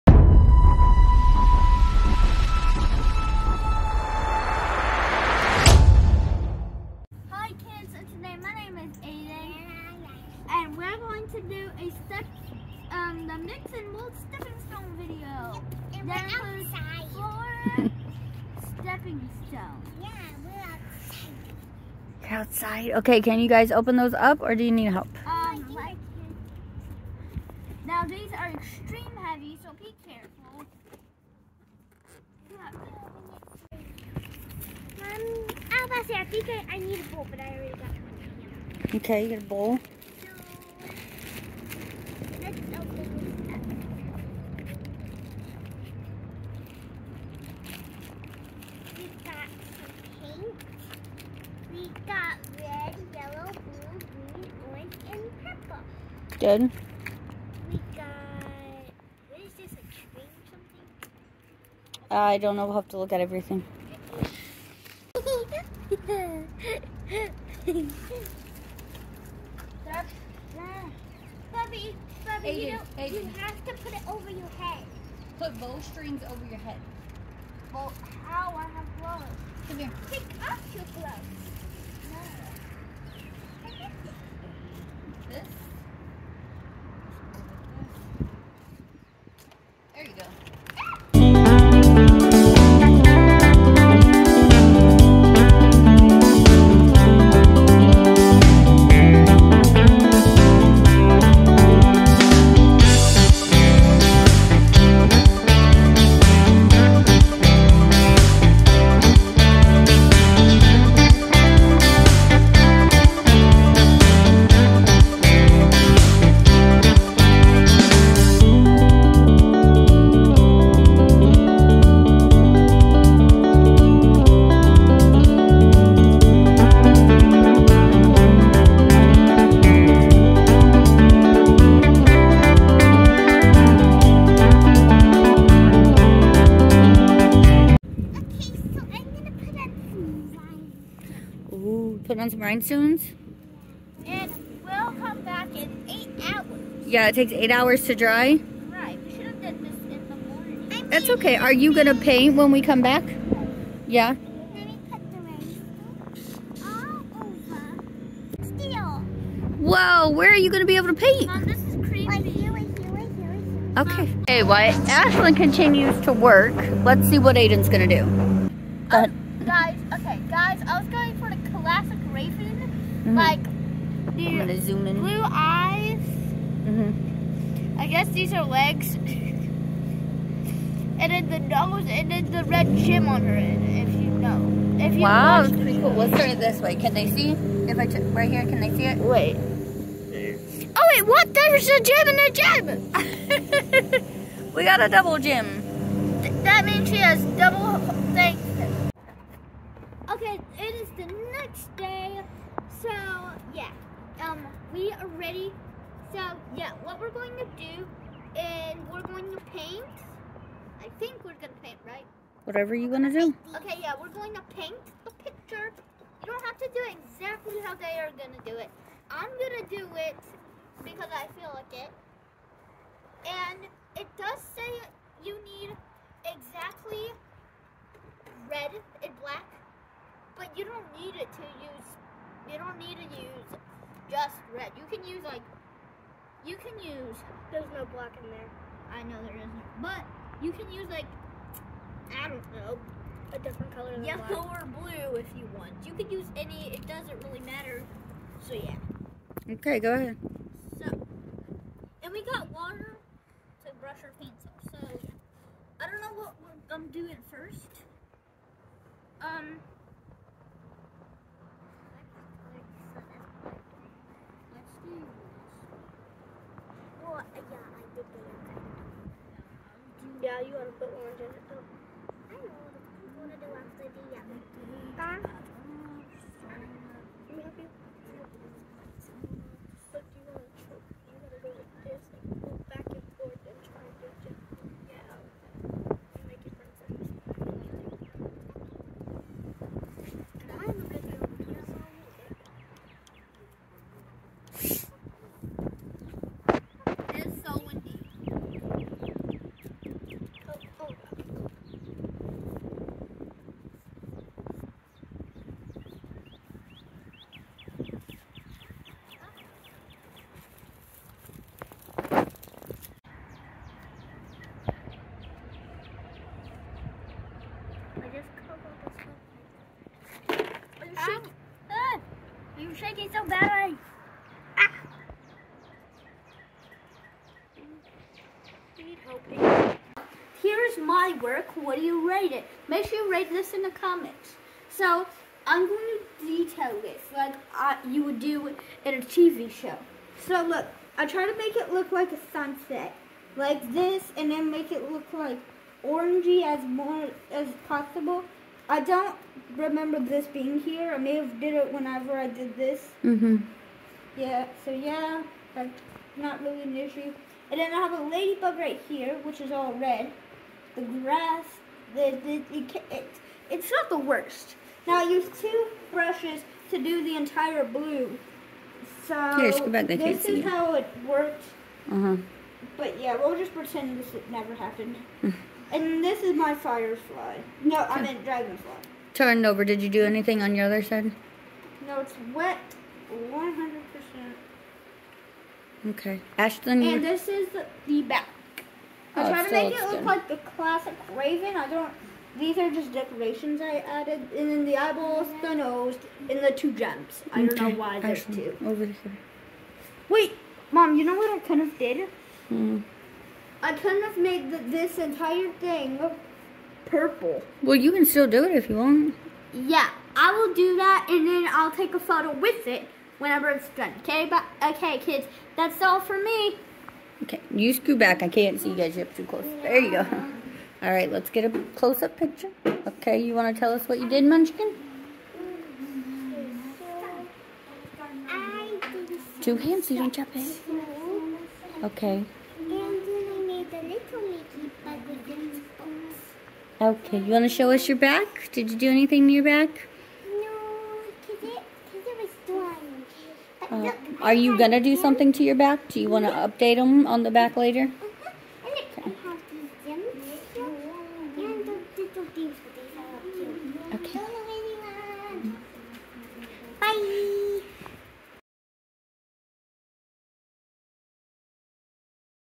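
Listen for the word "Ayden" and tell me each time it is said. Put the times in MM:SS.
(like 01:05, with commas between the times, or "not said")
01:12, 02:47.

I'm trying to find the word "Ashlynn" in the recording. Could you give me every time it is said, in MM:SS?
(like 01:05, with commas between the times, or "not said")
02:44.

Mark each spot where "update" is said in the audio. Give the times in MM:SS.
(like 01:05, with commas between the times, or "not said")
07:26.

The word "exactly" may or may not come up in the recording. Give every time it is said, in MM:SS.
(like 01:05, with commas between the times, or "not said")
03:36, 03:46.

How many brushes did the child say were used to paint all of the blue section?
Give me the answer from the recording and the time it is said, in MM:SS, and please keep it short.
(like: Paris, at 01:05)
2, at 06:05.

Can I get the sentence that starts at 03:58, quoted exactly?
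I know there isn't, but you can use like, I don't know, a different color than yellow black.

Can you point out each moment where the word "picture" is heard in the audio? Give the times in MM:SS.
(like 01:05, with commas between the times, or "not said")
03:35, 07:02.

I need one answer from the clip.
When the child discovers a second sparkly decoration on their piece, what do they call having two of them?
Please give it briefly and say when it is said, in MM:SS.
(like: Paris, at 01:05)
Double gym, at 03:14.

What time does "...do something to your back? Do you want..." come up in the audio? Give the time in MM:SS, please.
07:24.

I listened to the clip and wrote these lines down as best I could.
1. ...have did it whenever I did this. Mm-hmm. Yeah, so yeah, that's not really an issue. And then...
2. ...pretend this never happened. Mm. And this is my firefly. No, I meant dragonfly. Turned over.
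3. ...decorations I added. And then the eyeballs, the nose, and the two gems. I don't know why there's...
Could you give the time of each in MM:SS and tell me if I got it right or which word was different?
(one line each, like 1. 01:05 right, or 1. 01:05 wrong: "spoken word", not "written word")
1. 05:51 right
2. 06:13 right
3. 06:32 right.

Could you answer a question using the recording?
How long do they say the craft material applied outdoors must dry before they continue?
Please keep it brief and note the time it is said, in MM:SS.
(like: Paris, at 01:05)
8 hours, at 02:27.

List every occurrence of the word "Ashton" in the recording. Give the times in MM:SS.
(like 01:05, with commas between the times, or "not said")
06:26, 06:38.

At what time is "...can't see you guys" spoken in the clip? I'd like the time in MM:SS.
06:58.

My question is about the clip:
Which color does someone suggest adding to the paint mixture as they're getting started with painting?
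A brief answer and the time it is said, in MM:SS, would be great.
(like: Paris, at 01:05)
Orange, at 04:30.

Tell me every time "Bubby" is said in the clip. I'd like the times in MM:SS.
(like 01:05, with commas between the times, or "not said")
01:05, 01:12.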